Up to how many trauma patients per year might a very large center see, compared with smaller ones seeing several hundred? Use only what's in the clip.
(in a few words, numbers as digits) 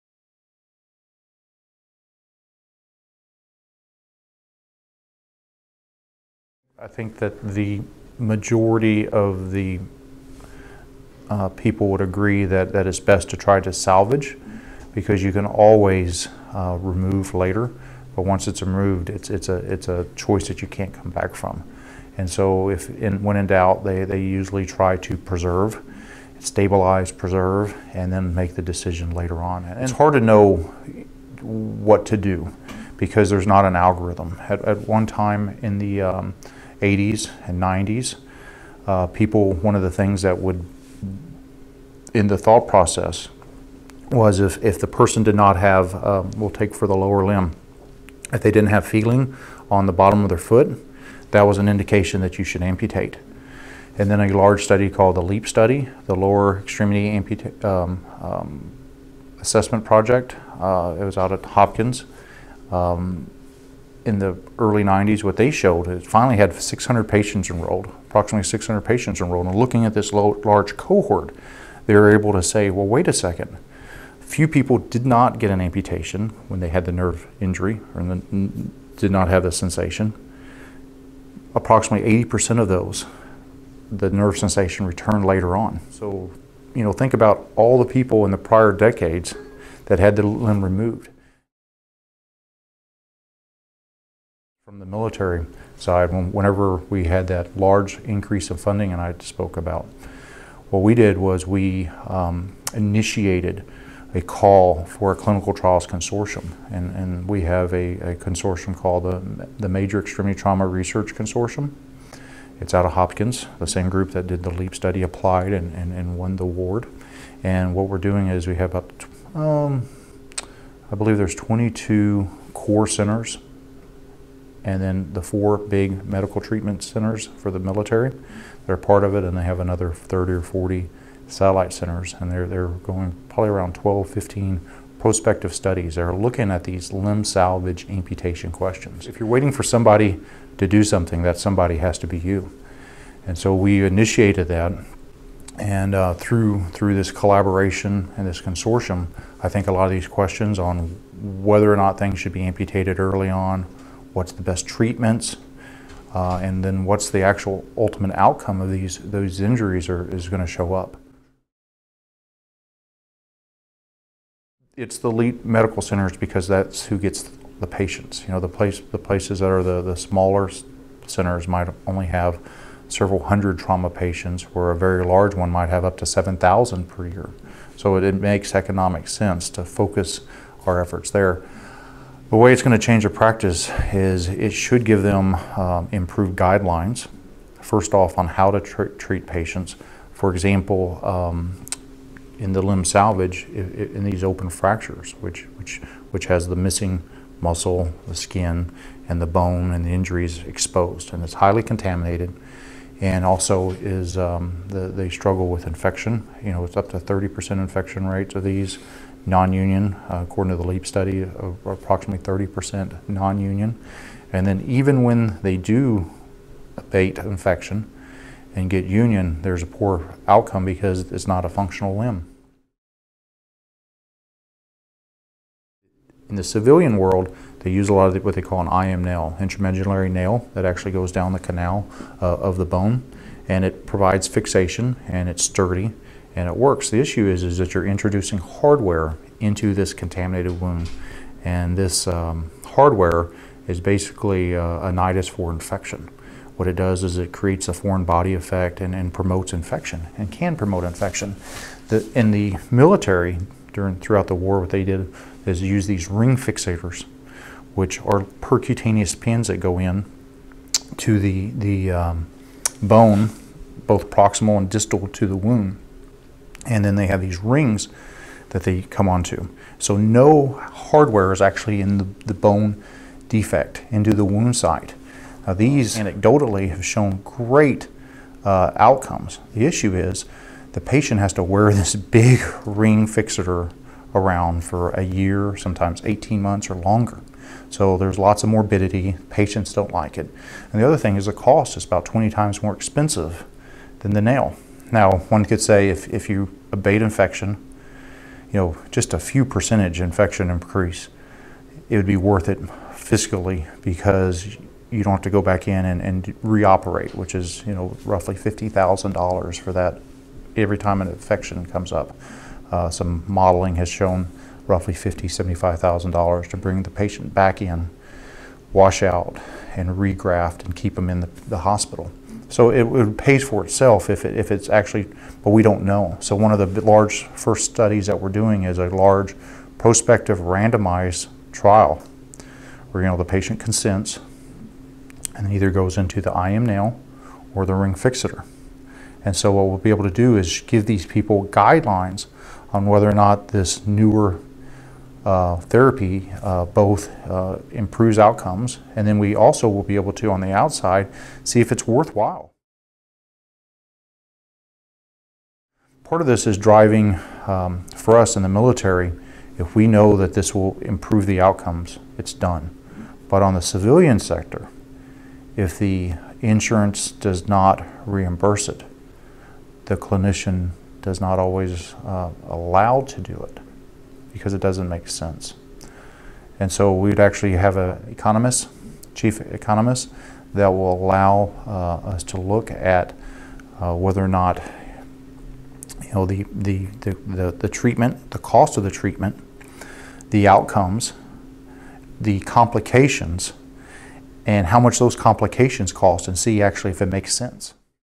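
7,000.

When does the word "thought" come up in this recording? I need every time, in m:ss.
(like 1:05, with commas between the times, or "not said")
0:42.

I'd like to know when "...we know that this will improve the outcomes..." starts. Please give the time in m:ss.
5:59.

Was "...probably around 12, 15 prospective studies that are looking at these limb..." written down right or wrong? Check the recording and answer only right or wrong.
right.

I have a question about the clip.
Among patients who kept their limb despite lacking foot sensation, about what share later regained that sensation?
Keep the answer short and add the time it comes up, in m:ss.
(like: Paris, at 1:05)
80%, at 1:21.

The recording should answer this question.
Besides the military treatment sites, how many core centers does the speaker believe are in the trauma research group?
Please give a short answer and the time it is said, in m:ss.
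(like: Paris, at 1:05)
22, at 2:01.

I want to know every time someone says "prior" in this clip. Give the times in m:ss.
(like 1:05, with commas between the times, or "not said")
1:28.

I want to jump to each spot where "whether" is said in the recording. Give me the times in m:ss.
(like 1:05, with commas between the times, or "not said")
2:31, 5:42, 6:23.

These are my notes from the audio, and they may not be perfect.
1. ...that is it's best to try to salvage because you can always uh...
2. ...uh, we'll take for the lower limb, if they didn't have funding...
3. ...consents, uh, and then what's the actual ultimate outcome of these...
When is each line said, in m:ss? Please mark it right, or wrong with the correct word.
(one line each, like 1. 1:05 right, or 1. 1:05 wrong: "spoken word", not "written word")
1. 0:12 right
2. 0:45 wrong: "feeling", not "funding"
3. 2:34 wrong: "treatments", not "consents".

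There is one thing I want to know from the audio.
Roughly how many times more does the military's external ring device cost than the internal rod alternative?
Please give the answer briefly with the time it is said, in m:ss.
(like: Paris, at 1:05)
20 times, at 4:52.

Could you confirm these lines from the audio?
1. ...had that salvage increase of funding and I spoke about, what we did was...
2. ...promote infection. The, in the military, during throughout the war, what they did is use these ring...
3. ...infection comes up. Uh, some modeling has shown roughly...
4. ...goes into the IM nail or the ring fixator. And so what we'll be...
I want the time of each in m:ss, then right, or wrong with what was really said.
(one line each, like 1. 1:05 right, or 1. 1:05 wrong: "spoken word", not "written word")
1. 1:37 wrong: "large", not "salvage"
2. 4:10 right
3. 5:11 right
4. 5:35 right.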